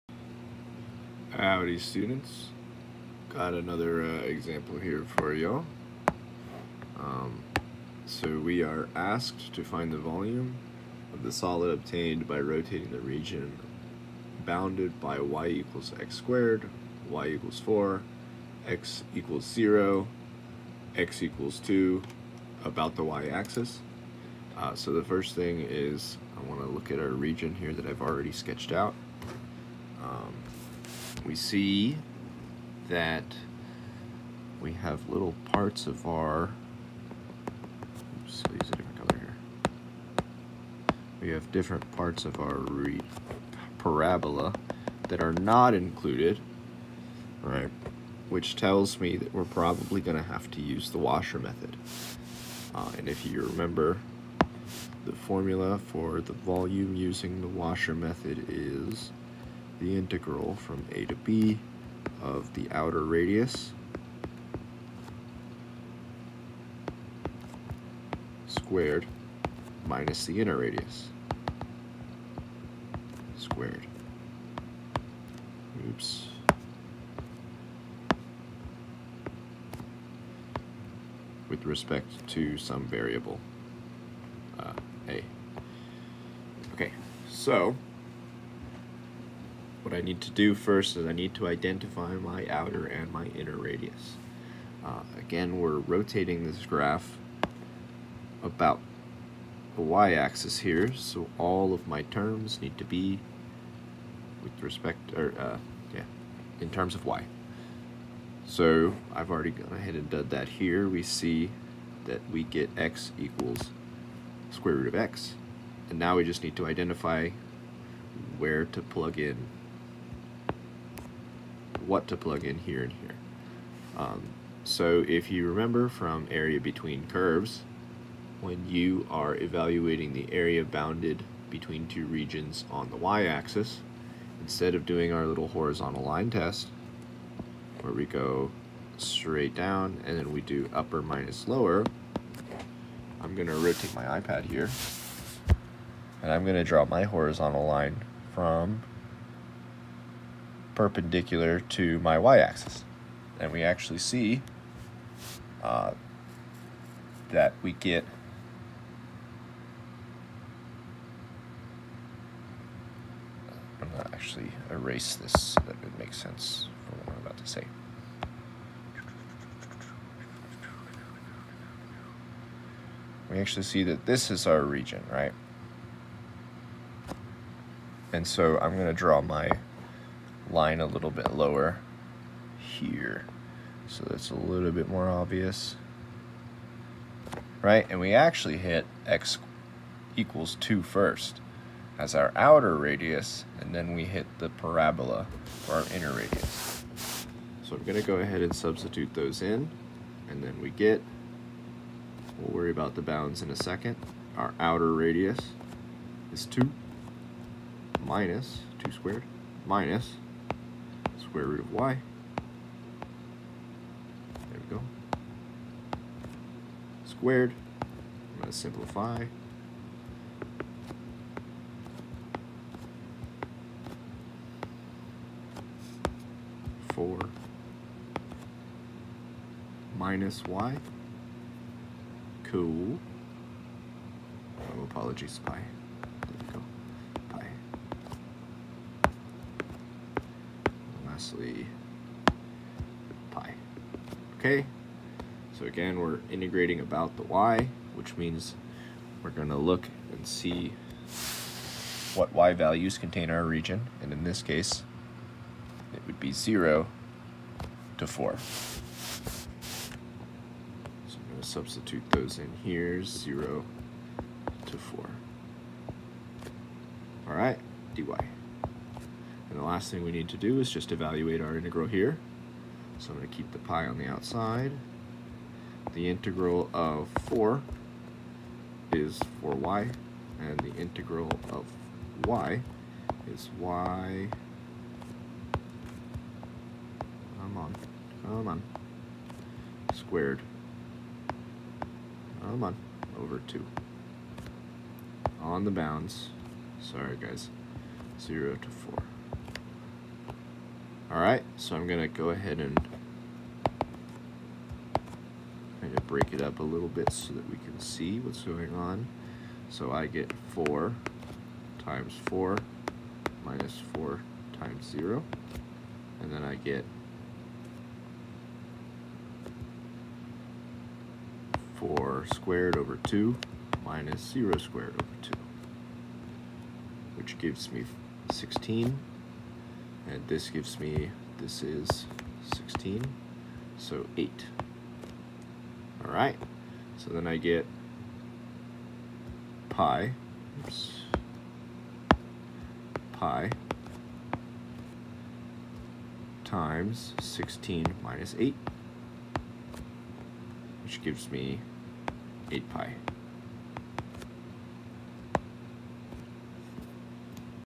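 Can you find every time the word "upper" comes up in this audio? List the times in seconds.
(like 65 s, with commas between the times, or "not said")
140 s.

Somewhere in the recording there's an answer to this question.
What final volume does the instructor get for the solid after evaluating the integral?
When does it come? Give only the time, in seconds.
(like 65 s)
352 s.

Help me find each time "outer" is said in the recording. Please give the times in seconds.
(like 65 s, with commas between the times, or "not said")
62 s, 92 s, 192 s, 204 s.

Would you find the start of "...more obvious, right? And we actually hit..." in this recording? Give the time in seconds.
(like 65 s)
184 s.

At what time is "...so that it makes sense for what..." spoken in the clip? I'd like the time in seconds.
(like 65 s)
165 s.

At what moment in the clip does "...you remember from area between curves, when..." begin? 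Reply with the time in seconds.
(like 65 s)
125 s.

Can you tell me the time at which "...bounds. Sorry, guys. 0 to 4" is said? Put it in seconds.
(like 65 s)
295 s.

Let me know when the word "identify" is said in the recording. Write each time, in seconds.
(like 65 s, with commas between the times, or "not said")
91 s, 116 s.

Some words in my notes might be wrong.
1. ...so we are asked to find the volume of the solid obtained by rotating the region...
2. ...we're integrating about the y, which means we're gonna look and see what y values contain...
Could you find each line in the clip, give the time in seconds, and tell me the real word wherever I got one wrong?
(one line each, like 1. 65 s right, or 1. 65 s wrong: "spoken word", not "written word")
1. 8 s right
2. 245 s right.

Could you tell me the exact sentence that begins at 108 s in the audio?
So I've already gone ahead and done that here.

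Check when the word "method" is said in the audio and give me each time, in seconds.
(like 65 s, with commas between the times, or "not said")
51 s, 57 s.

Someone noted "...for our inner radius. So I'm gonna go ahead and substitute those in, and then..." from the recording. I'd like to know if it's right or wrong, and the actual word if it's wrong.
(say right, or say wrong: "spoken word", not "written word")
right.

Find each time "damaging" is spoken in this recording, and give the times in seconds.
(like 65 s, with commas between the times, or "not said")
not said.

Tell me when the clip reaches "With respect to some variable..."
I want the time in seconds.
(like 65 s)
81 s.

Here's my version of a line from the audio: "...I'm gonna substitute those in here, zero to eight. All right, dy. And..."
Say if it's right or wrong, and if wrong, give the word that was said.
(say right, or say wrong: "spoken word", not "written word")
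wrong: "four", not "eight".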